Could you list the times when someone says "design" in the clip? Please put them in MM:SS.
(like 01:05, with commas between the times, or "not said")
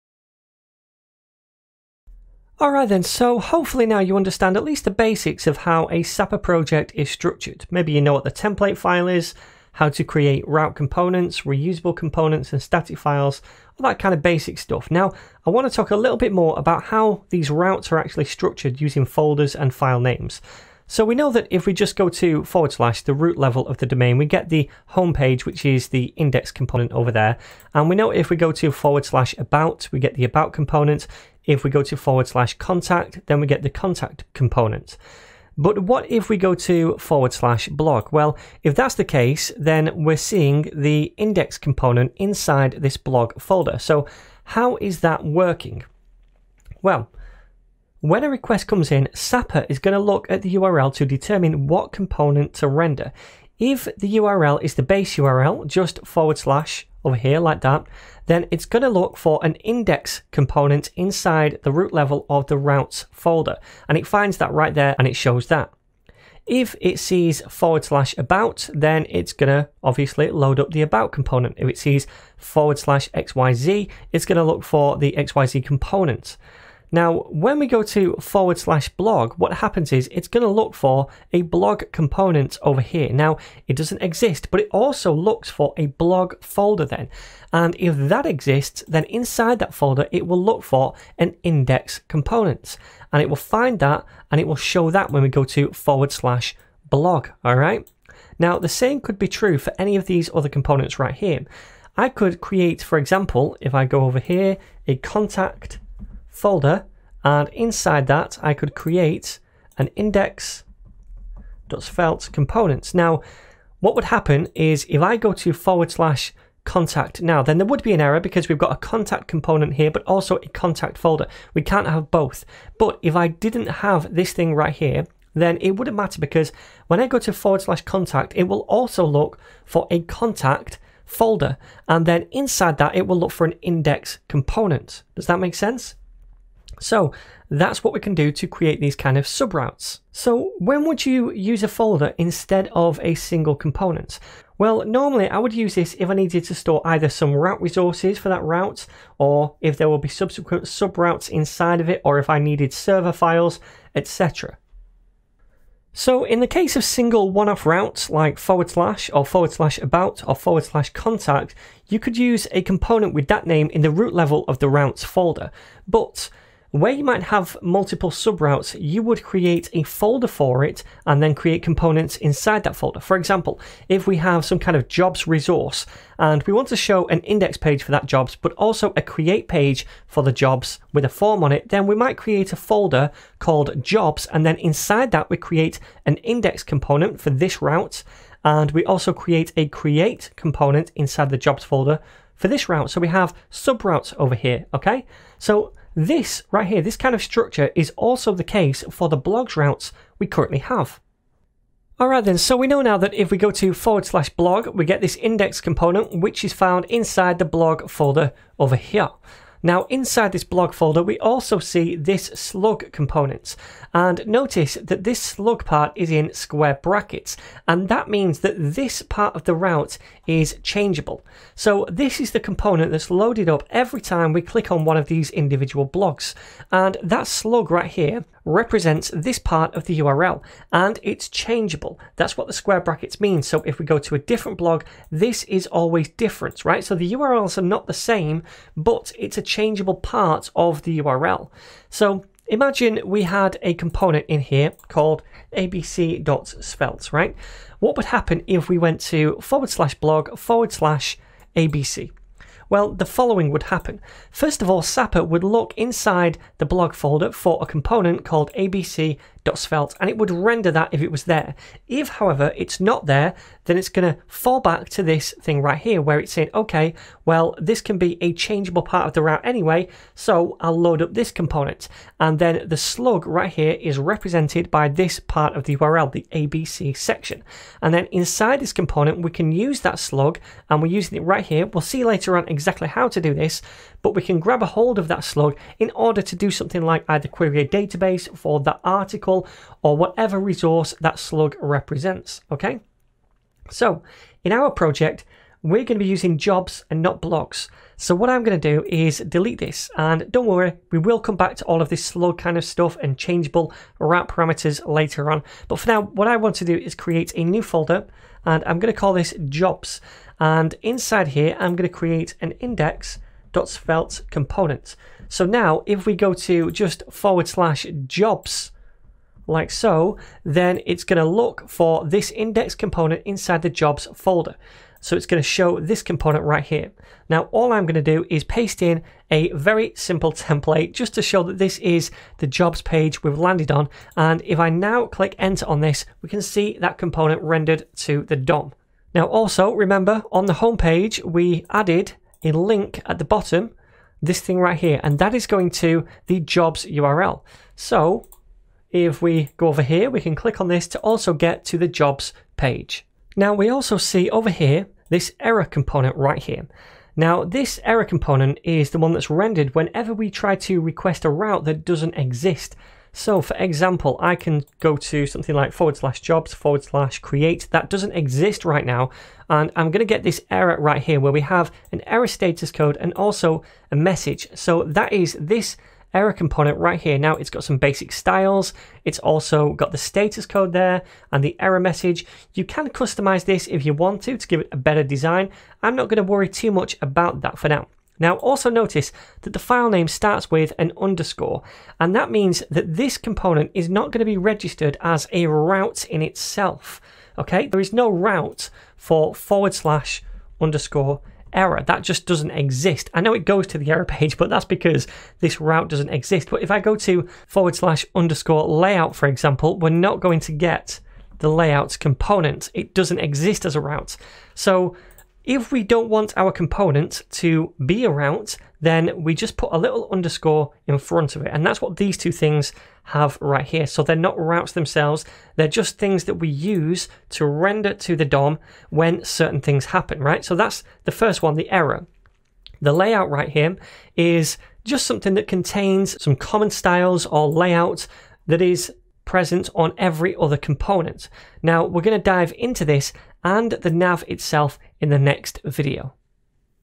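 06:25.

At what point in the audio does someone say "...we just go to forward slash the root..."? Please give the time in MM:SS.
00:21.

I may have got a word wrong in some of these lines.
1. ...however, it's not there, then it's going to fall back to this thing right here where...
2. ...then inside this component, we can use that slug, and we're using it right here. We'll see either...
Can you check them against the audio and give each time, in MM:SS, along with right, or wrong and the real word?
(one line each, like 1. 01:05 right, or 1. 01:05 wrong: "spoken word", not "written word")
1. 04:22 right
2. 04:37 wrong: "later", not "either".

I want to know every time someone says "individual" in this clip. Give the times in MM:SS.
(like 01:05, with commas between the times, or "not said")
03:45.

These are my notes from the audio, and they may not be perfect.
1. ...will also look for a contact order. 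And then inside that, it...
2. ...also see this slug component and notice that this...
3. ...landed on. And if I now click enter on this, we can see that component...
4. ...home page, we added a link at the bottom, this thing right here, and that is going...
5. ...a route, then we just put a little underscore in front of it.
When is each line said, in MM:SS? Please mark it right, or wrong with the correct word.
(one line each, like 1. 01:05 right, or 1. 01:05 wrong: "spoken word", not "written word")
1. 02:08 wrong: "folder", not "order"
2. 03:31 right
3. 05:33 right
4. 05:40 right
5. 06:58 right.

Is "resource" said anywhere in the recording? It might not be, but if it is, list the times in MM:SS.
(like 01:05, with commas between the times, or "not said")
02:27, 02:55, 04:50.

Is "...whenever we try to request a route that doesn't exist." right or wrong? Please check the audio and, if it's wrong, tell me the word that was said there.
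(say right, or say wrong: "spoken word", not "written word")
right.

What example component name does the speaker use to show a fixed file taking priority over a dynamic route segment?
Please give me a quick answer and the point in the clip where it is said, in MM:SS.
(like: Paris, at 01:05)
abc.svelte, at 04:05.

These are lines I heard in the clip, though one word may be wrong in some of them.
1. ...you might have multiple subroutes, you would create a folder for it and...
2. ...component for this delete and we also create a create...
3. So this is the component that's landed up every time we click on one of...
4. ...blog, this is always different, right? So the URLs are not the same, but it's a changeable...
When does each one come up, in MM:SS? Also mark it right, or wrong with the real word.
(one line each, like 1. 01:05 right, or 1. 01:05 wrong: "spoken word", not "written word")
1. 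02:46 right
2. 03:06 wrong: "route", not "delete"
3. 03:41 wrong: "loaded", not "landed"
4. 03:54 right.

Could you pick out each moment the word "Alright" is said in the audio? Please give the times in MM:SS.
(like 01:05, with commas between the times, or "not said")
00:02, 03:21.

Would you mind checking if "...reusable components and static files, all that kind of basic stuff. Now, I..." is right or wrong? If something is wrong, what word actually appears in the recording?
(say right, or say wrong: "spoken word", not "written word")
right.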